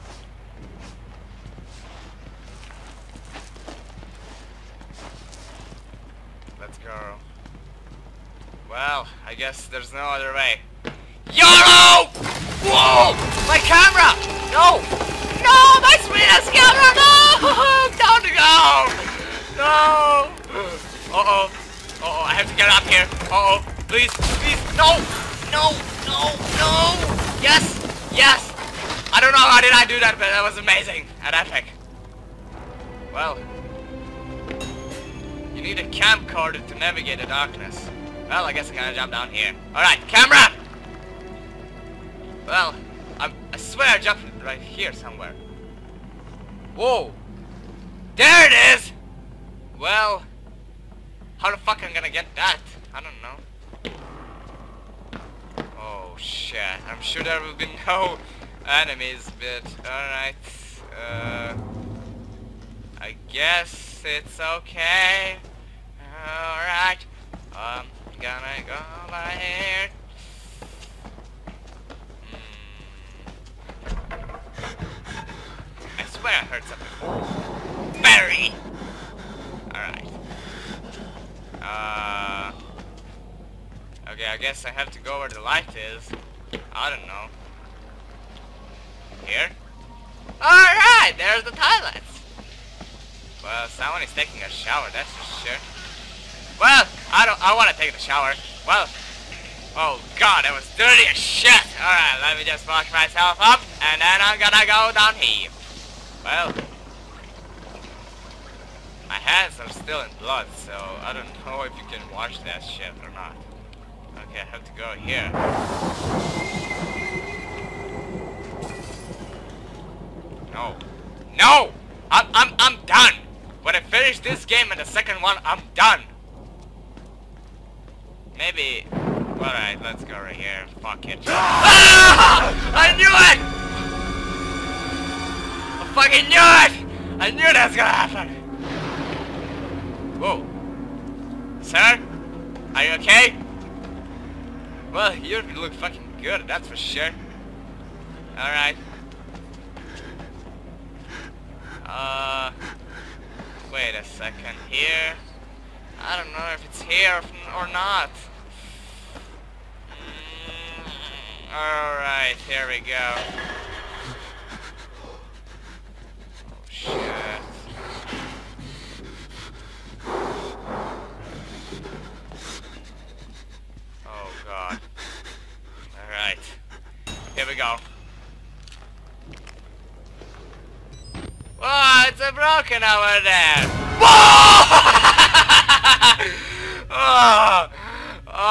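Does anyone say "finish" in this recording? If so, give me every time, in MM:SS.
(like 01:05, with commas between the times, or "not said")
02:03.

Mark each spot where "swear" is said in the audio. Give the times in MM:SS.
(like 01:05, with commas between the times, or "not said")
00:43, 01:16.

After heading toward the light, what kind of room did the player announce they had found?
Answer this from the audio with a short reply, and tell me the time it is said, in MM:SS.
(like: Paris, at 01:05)
the toilets, at 01:31.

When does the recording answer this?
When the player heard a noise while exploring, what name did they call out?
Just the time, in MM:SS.
01:18.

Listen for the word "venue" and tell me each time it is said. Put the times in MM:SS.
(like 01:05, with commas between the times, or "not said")
not said.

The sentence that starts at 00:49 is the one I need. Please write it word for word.
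Well, how the fuck I'm gonna get that?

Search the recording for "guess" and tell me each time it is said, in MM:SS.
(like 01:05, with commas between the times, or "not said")
00:09, 00:38, 01:03, 01:24.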